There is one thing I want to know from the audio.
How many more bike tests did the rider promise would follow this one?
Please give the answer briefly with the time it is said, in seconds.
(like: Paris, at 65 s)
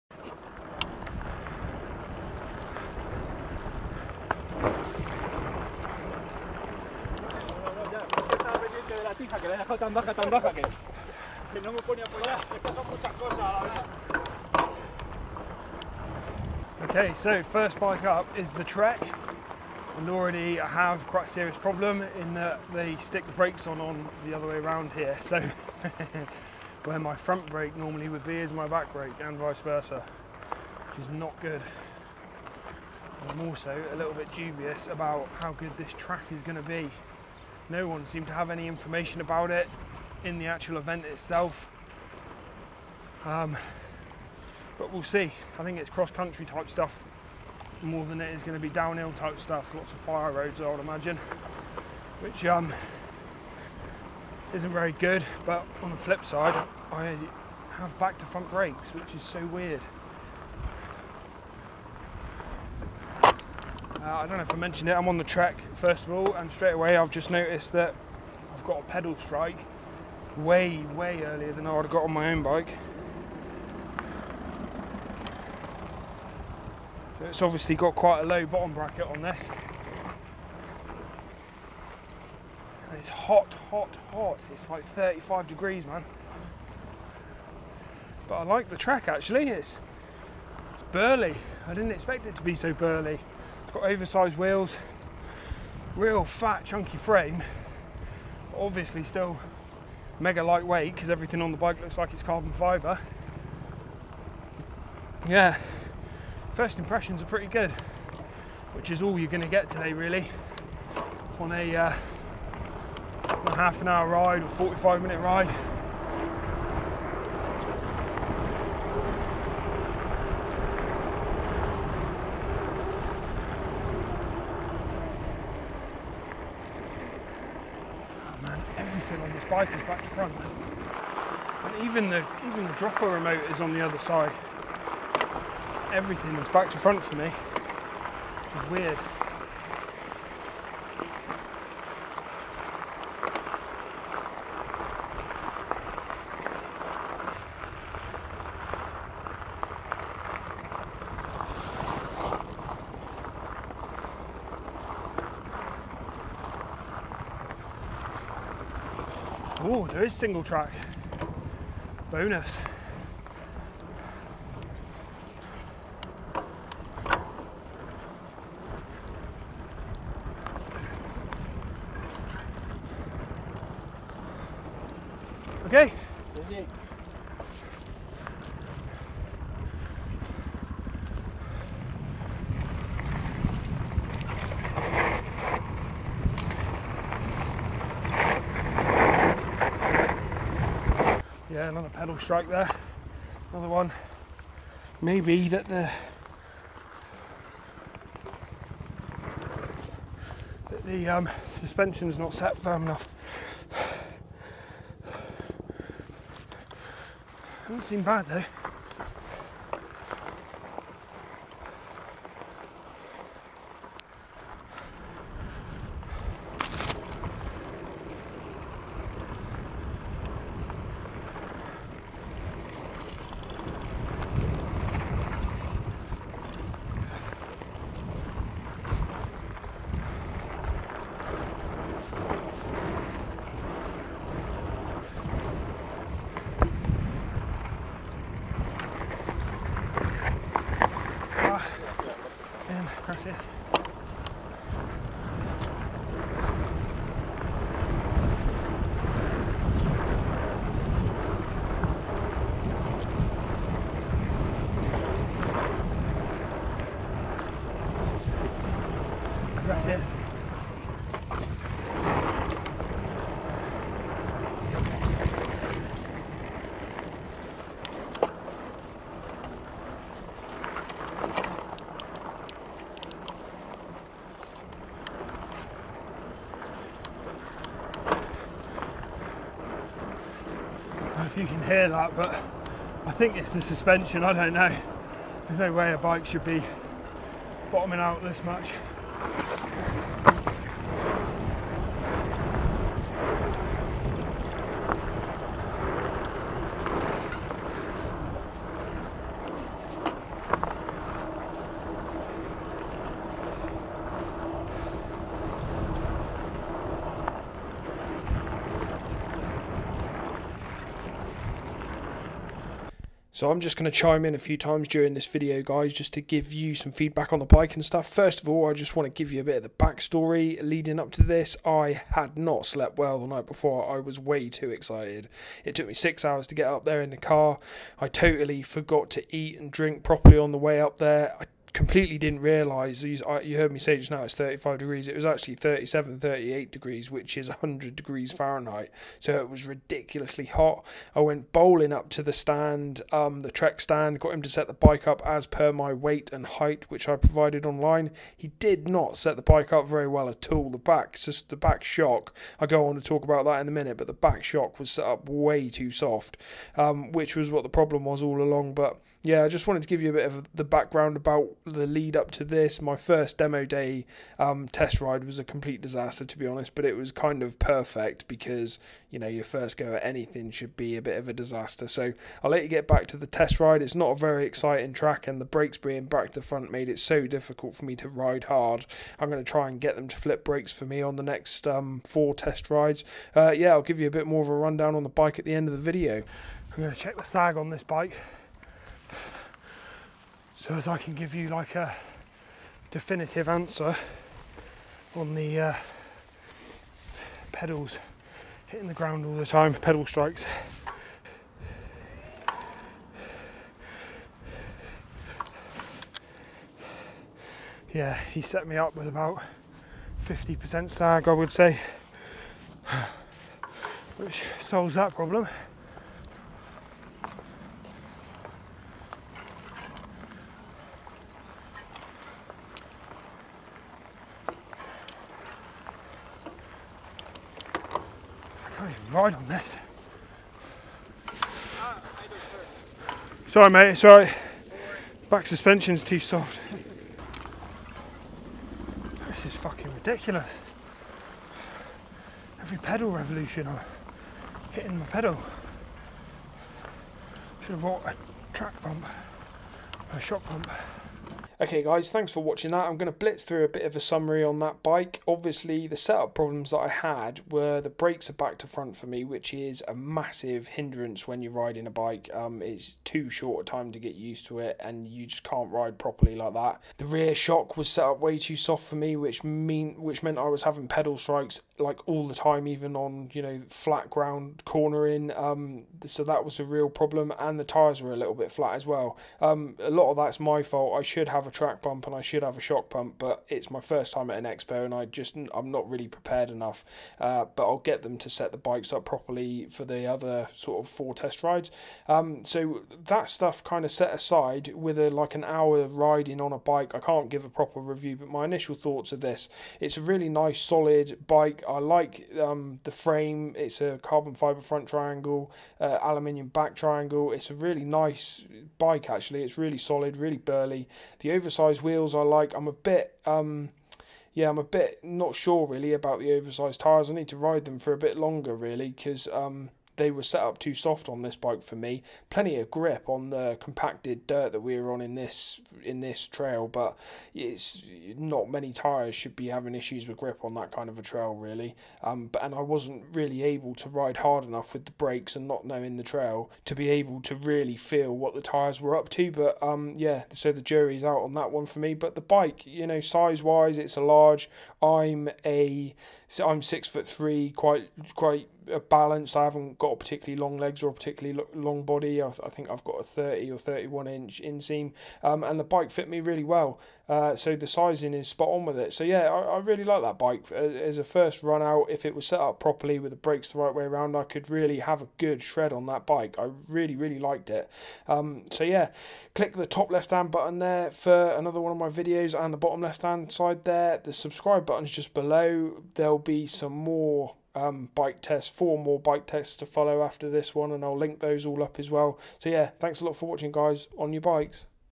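4, at 578 s.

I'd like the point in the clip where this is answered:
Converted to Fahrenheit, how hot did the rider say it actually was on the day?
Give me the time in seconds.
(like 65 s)
337 s.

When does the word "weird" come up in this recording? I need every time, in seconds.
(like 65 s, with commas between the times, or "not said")
59 s, 138 s.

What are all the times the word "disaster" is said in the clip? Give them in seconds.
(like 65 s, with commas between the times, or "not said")
365 s, 371 s.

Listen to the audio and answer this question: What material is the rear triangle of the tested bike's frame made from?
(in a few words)
aluminium.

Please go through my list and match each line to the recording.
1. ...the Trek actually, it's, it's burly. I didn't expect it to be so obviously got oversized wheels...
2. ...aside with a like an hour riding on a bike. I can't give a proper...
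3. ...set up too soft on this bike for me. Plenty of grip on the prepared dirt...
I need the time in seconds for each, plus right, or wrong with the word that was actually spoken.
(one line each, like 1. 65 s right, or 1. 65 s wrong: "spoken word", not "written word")
1. 88 s wrong: "burly", not "obviously"
2. 494 s right
3. 520 s wrong: "compacted", not "prepared".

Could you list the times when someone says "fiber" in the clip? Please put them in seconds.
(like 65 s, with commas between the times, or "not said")
102 s, 504 s.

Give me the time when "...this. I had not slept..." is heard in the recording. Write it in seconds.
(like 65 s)
321 s.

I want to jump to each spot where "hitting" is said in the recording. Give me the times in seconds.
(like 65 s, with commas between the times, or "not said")
398 s, 444 s.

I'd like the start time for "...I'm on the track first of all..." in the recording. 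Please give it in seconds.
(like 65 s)
64 s.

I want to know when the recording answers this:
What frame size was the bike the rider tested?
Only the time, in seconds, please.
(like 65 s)
543 s.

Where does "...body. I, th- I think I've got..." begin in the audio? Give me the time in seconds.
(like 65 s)
551 s.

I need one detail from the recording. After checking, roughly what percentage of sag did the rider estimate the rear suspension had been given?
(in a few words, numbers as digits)
50%.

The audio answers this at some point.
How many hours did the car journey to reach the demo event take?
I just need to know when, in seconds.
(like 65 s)
325 s.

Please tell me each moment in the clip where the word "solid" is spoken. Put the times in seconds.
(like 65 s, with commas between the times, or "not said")
500 s, 509 s.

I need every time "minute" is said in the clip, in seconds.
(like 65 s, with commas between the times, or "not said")
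115 s, 353 s.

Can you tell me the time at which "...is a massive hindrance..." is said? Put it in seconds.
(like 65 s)
459 s.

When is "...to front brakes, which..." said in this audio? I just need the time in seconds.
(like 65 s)
58 s.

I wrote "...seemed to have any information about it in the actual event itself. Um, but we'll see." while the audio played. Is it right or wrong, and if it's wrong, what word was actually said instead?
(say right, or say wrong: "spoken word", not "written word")
right.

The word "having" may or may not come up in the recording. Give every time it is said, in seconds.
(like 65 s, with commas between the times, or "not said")
470 s, 529 s.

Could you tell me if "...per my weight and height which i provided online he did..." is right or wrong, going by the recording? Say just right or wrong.
right.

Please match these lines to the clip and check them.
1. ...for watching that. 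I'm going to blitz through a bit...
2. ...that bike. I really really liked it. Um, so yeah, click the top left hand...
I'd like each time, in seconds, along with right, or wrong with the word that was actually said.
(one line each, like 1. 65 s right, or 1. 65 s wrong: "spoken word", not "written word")
1. 452 s right
2. 565 s right.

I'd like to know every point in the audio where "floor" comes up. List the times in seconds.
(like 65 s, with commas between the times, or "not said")
not said.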